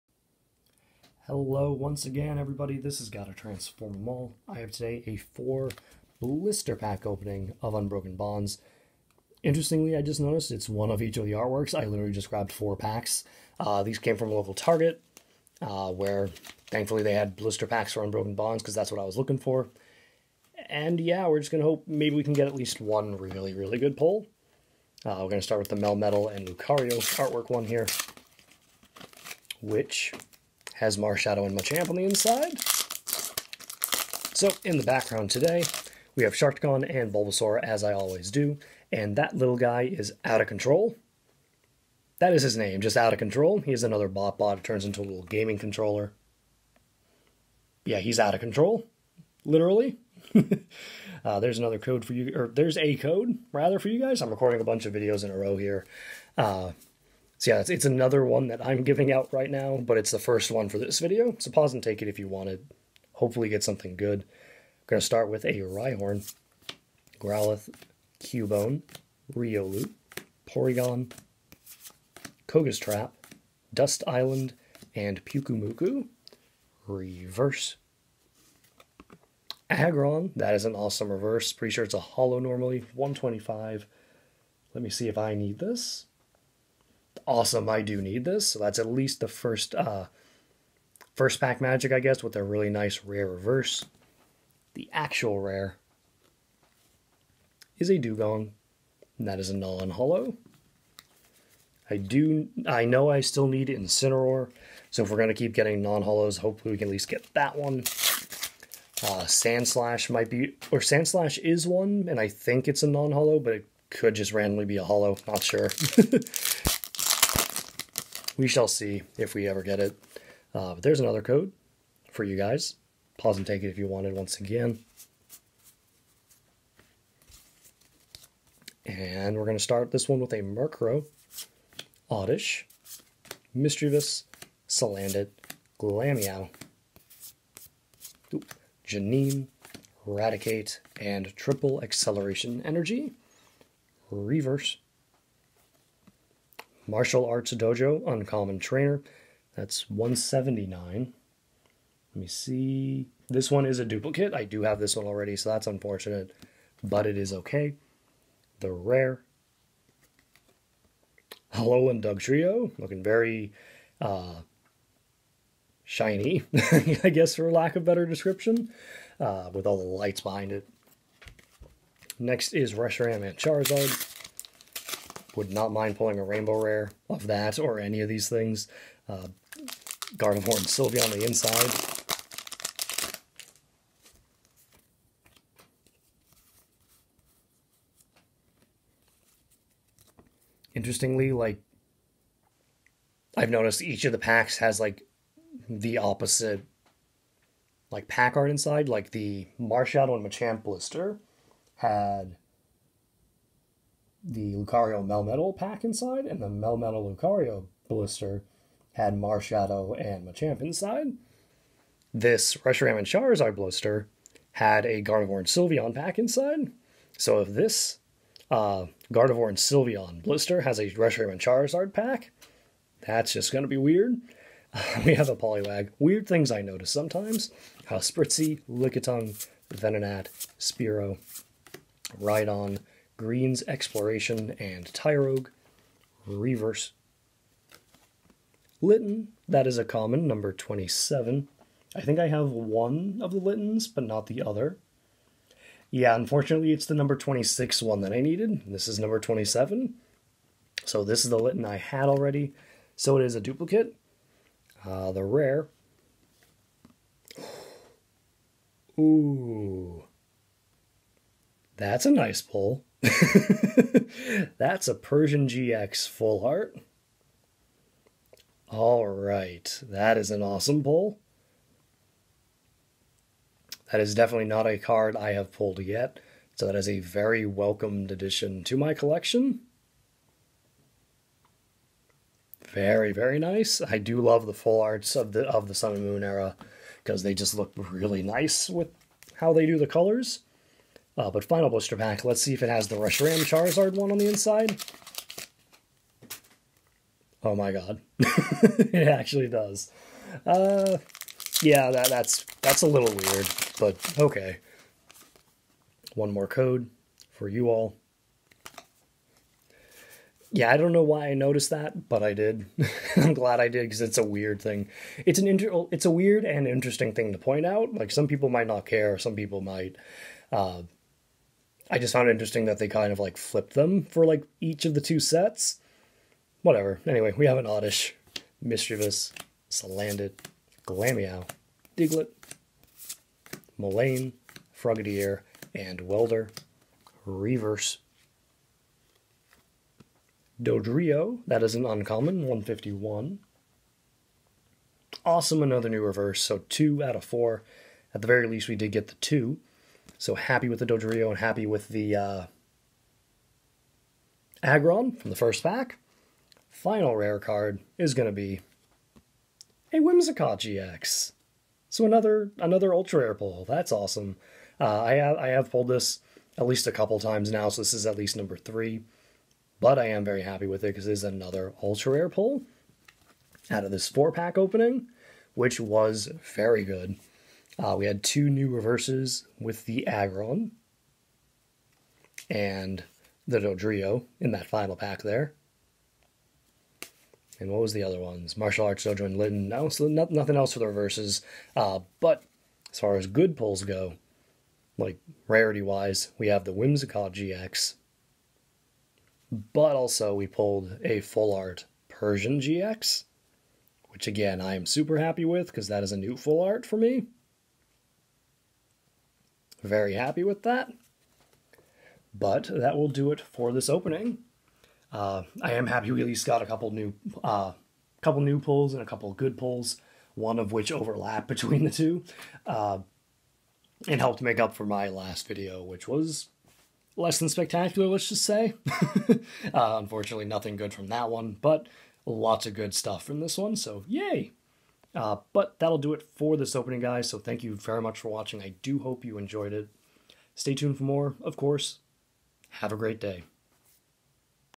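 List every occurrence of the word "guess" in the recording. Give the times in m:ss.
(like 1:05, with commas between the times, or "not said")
1:31, 2:47.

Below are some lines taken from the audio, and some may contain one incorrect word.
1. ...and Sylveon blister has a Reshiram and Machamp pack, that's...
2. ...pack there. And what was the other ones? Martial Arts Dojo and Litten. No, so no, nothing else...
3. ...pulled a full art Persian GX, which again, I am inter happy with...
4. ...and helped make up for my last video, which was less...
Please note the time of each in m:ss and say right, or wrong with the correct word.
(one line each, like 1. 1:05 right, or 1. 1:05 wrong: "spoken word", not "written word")
1. 3:39 wrong: "Charizard", not "Machamp"
2. 6:24 right
3. 6:40 wrong: "super", not "inter"
4. 7:04 right.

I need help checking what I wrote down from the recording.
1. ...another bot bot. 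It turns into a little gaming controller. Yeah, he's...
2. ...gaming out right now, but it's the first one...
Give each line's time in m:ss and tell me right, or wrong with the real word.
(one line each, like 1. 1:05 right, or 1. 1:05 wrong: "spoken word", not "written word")
1. 0:43 right
2. 0:58 wrong: "giving", not "gaming".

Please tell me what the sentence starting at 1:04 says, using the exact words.
I'm going to start with a Rhyhorn, Growlithe, Cubone, Riolu, Porygon, Koga's Trap, Dust Island, and Pyukumuku.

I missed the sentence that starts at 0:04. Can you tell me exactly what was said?
I have today a 4 blister pack opening of Unbroken Bonds.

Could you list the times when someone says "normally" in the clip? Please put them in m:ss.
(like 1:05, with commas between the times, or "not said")
1:22.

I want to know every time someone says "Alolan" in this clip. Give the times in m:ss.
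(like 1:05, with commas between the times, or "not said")
2:41.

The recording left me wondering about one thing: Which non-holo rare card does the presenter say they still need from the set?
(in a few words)
Incineroar.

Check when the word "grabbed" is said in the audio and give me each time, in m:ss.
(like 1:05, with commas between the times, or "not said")
0:12.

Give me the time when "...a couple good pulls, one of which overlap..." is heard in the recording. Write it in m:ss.
6:59.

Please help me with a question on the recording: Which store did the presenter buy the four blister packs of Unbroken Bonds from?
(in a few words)
Target.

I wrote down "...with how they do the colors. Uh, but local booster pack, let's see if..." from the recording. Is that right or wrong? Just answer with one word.
wrong.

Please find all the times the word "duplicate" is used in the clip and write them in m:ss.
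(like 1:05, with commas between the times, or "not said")
2:33, 4:13.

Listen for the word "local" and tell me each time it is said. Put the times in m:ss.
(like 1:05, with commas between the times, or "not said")
0:14.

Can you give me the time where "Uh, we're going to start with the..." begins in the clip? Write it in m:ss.
0:25.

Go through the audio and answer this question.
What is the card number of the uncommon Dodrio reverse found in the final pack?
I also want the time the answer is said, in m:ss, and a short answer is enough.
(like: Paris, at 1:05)
151, at 5:42.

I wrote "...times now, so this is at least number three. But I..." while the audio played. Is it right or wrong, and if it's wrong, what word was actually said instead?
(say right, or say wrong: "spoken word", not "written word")
right.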